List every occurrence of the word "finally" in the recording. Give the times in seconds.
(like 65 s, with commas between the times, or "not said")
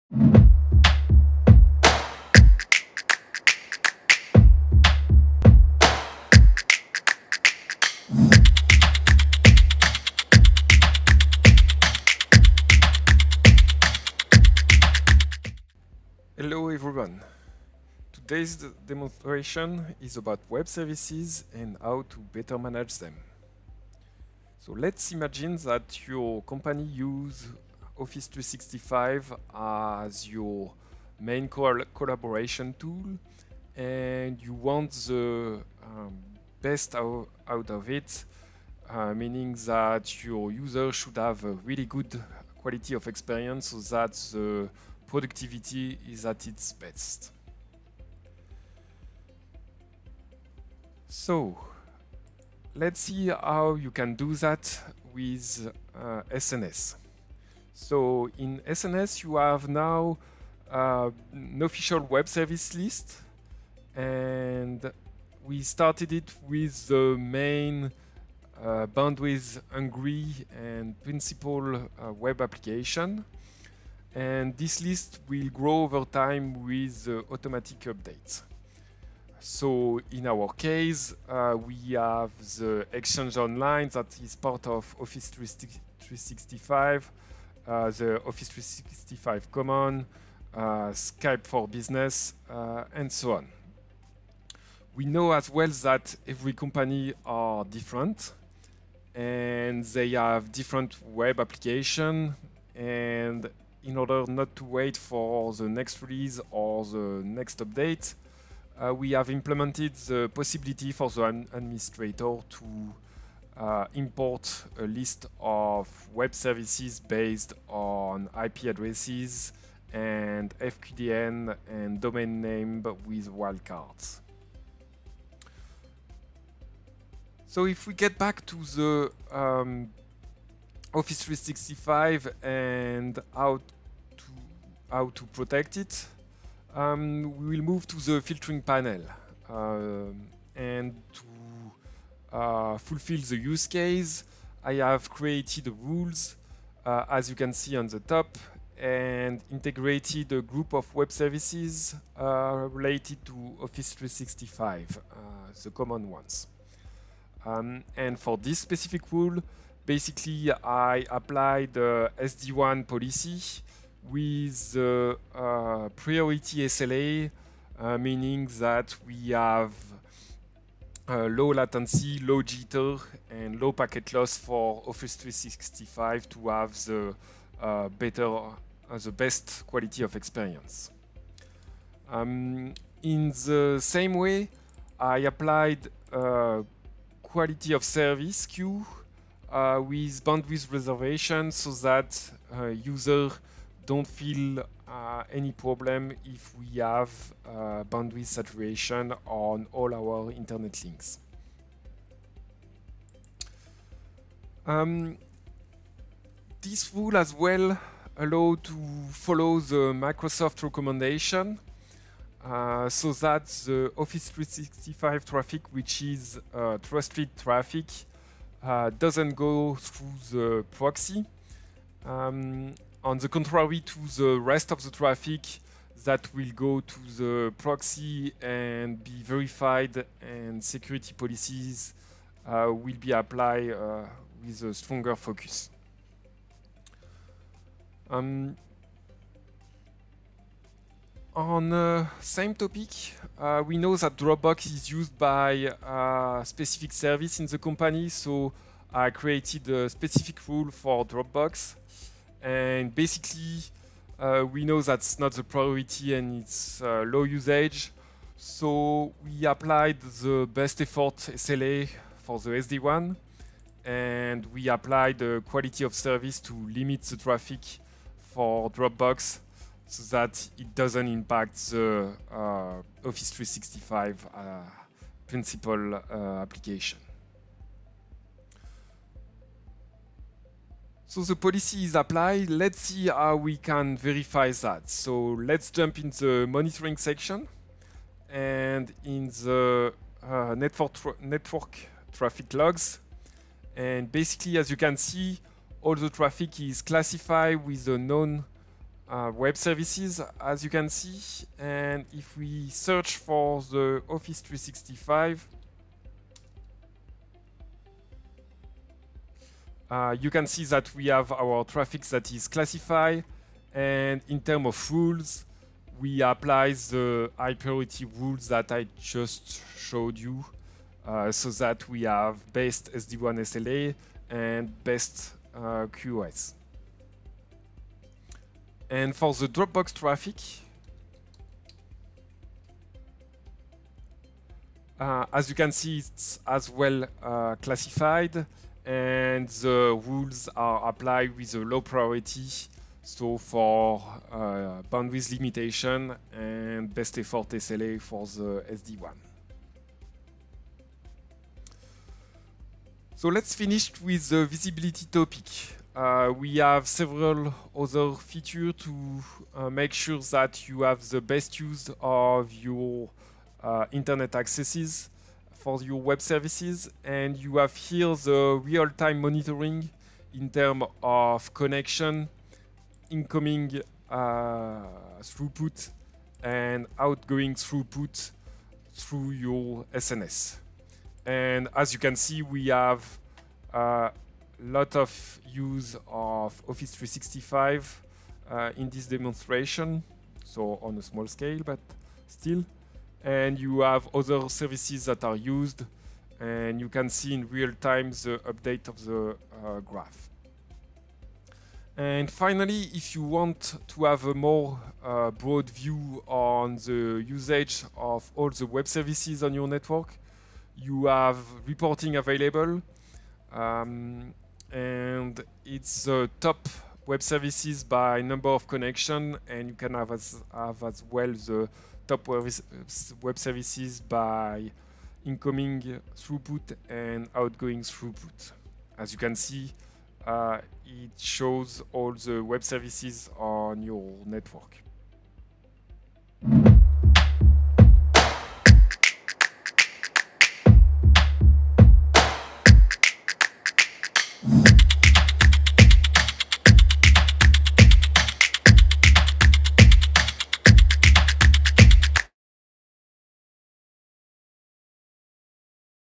402 s.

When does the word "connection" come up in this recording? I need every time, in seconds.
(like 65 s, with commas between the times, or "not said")
371 s, 418 s.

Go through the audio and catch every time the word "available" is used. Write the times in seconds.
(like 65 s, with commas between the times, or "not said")
412 s.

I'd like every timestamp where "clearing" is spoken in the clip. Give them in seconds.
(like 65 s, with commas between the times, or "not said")
not said.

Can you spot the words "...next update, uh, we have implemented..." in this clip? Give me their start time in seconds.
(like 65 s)
107 s.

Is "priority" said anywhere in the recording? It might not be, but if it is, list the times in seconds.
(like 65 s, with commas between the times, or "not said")
165 s, 255 s, 317 s, 341 s.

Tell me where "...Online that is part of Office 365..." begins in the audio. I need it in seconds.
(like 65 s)
83 s.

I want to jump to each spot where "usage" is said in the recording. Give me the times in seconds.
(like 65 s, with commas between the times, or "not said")
257 s, 407 s.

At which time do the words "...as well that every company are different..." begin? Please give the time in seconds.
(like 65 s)
95 s.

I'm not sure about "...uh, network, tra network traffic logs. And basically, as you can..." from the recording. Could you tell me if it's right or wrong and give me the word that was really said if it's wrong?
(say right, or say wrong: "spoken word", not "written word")
right.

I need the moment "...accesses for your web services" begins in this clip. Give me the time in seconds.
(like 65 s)
364 s.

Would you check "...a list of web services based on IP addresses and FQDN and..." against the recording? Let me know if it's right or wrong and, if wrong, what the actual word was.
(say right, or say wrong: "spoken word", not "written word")
right.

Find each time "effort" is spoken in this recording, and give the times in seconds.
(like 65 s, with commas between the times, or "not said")
260 s, 347 s.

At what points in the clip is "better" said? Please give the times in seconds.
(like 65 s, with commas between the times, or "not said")
22 s, 177 s.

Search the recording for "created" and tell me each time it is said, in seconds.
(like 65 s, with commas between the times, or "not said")
145 s, 249 s.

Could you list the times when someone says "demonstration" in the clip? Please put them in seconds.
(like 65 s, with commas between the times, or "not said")
18 s, 389 s.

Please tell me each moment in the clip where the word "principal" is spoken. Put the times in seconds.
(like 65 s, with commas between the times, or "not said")
71 s, 275 s.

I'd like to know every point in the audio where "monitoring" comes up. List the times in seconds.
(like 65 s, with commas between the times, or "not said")
286 s, 369 s.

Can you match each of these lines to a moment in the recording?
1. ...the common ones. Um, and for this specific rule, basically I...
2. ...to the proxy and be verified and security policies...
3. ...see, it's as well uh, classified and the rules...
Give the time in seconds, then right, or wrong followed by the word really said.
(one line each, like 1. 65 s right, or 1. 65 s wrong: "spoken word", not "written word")
1. 155 s right
2. 226 s right
3. 335 s right.